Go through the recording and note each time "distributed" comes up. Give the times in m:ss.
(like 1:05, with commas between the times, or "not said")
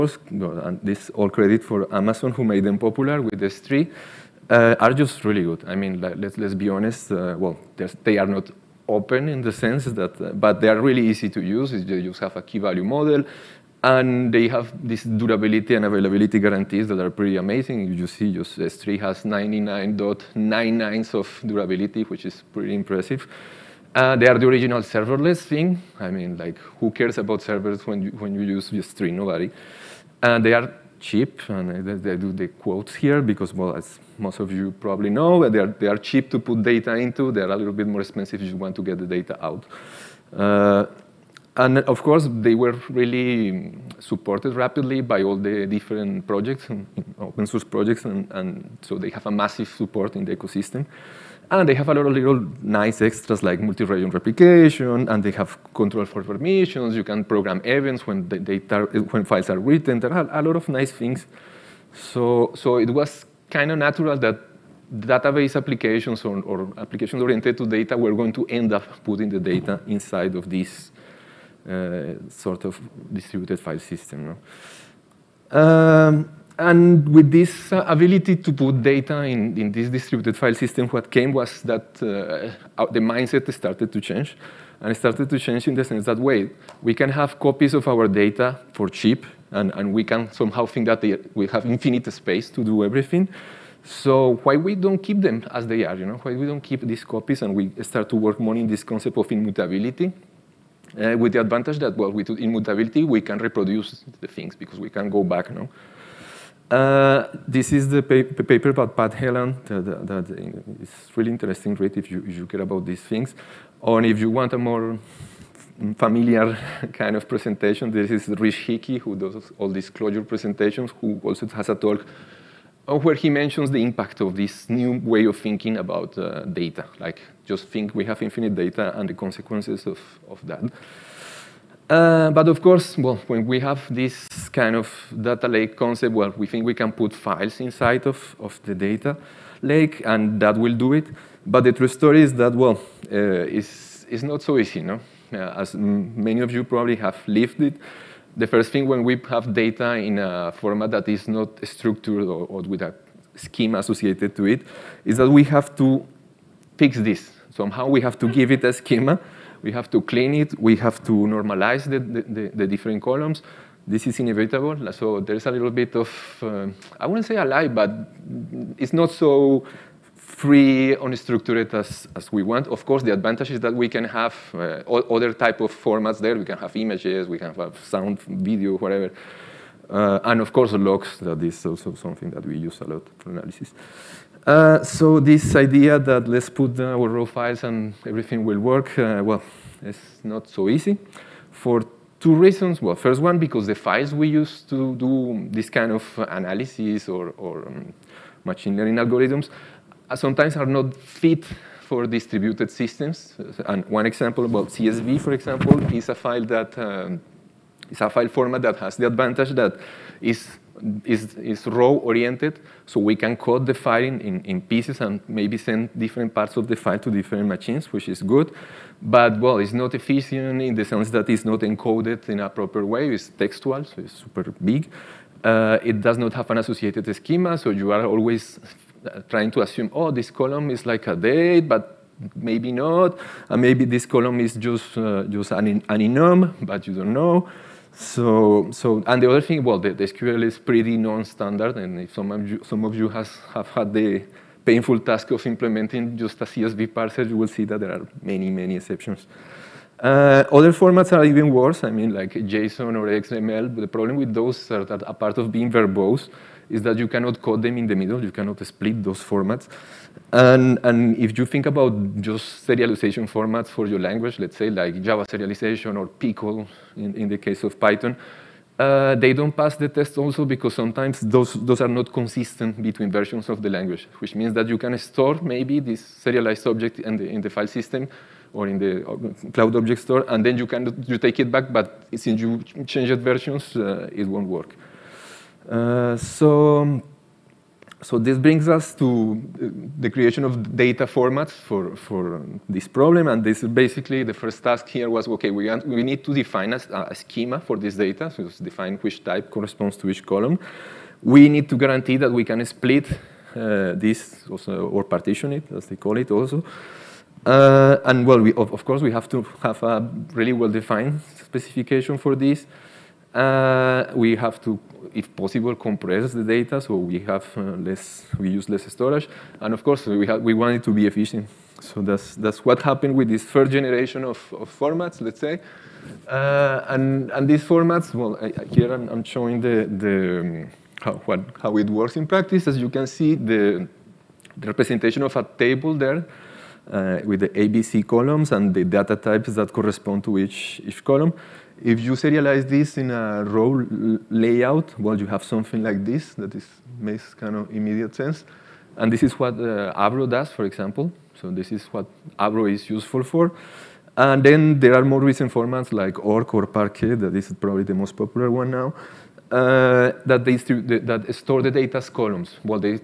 1:13, 1:19, 3:22.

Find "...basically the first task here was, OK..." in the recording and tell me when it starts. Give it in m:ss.
4:53.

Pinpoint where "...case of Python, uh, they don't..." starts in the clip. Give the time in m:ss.
4:27.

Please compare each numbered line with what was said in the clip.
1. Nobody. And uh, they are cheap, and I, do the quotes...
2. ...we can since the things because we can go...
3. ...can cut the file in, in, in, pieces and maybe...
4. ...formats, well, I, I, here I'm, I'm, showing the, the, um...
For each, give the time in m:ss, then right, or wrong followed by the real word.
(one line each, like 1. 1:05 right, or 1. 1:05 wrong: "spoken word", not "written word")
1. 0:29 right
2. 1:43 wrong: "reproduce", not "since"
3. 3:33 right
4. 5:27 right.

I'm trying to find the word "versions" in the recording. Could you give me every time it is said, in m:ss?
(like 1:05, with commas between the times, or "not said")
4:33, 4:43.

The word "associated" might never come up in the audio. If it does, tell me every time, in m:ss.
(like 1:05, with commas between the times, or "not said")
2:33, 3:46.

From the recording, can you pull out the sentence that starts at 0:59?
There are a lot of nice things.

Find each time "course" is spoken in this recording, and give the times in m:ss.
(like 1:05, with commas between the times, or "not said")
0:42, 2:12, 2:52, 3:00, 5:08, 5:19.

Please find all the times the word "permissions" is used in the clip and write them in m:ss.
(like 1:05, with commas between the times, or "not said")
0:56.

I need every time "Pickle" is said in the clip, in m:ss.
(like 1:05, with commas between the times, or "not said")
4:26.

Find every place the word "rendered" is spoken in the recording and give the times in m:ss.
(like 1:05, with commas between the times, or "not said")
not said.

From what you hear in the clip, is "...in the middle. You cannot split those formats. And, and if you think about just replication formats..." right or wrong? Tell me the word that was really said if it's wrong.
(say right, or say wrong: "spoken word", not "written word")
wrong: "serialization", not "replication".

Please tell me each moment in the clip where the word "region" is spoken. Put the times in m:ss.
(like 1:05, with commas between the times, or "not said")
0:53.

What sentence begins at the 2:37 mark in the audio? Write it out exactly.
Somehow we have to give it a schema, we have to clean it, we have to normalize the, the, the different columns.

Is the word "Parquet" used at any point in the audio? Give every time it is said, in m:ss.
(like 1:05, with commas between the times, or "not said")
5:56.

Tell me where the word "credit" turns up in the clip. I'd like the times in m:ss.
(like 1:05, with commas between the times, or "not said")
0:01.